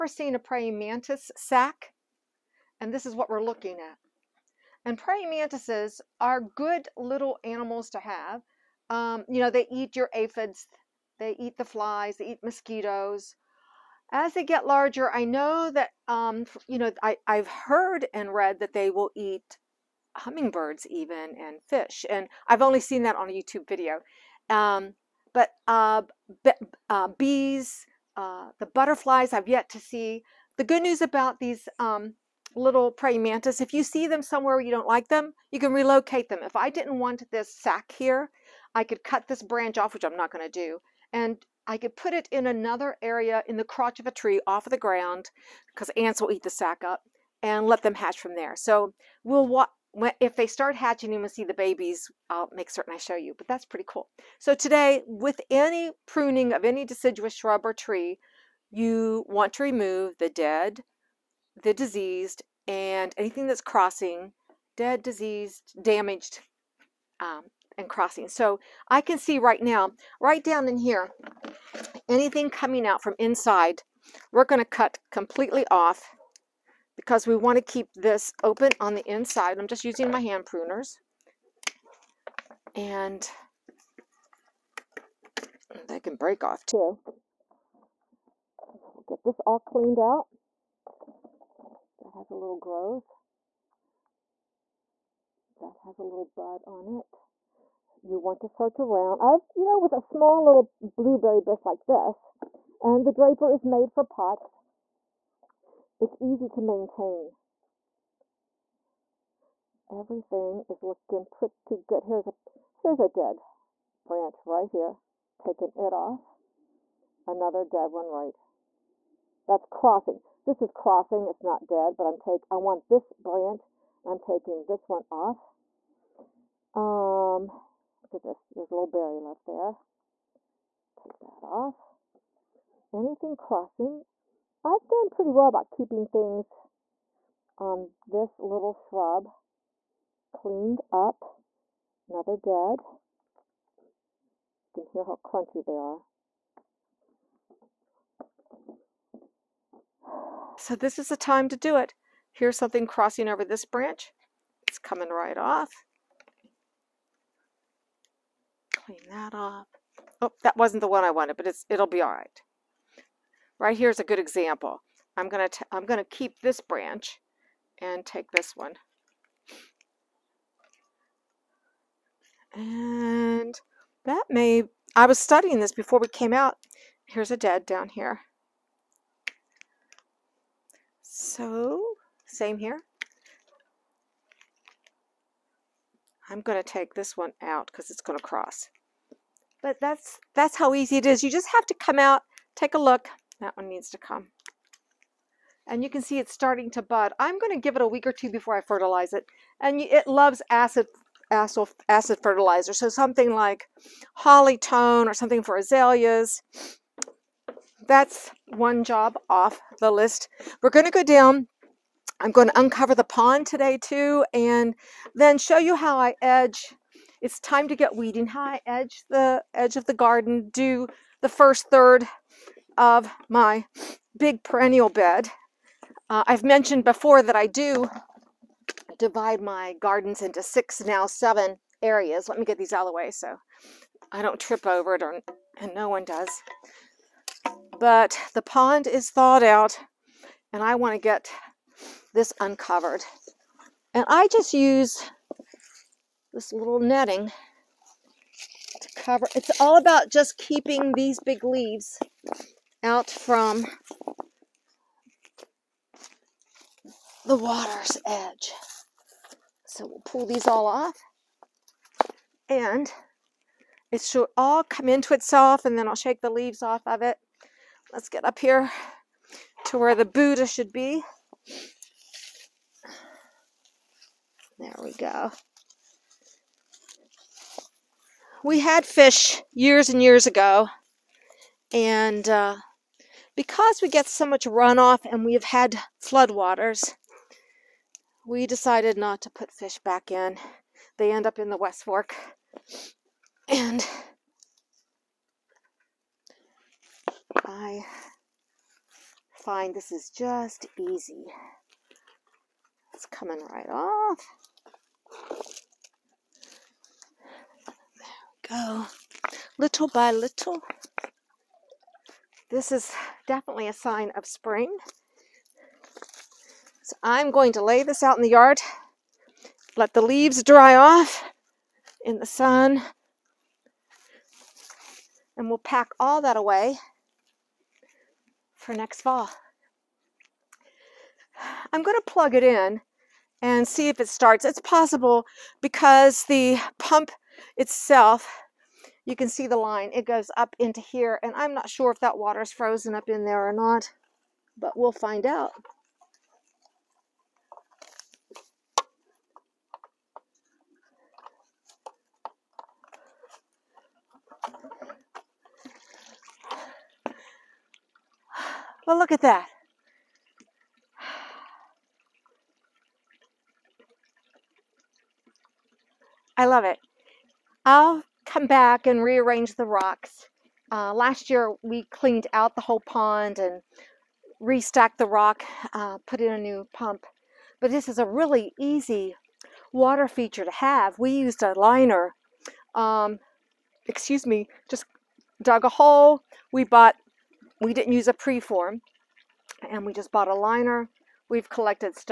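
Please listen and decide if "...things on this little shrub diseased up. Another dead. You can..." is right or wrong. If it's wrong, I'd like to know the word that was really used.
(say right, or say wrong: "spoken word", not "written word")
wrong: "cleaned", not "diseased".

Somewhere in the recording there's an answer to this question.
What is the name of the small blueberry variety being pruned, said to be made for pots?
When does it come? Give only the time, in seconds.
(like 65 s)
103 s.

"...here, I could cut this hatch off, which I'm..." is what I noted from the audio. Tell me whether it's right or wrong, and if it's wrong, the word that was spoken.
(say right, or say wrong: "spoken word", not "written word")
wrong: "branch", not "hatch".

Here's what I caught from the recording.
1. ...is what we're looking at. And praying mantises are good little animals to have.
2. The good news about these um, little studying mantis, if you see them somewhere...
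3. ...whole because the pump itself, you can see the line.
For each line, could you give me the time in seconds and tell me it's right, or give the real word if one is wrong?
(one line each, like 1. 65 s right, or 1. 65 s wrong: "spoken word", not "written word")
1. 3 s right
2. 30 s wrong: "praying", not "studying"
3. 334 s wrong: "possible", not "whole".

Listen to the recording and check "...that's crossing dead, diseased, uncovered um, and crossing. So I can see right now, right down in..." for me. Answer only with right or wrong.
wrong.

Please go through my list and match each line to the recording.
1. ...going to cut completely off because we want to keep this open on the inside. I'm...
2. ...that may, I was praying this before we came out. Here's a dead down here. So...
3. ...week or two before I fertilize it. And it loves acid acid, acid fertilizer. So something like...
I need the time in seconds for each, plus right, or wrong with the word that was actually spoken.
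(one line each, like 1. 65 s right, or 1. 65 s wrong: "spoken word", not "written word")
1. 74 s right
2. 174 s wrong: "studying", not "praying"
3. 197 s right.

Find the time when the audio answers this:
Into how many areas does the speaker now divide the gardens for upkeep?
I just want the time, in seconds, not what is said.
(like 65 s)
231 s.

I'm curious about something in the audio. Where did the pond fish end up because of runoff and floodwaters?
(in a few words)
The West Fork.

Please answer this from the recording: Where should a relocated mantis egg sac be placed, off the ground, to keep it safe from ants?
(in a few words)
Crotch of a tree.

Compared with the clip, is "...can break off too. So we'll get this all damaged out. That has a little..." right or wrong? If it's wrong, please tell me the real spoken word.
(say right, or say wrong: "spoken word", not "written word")
wrong: "cleaned", not "damaged".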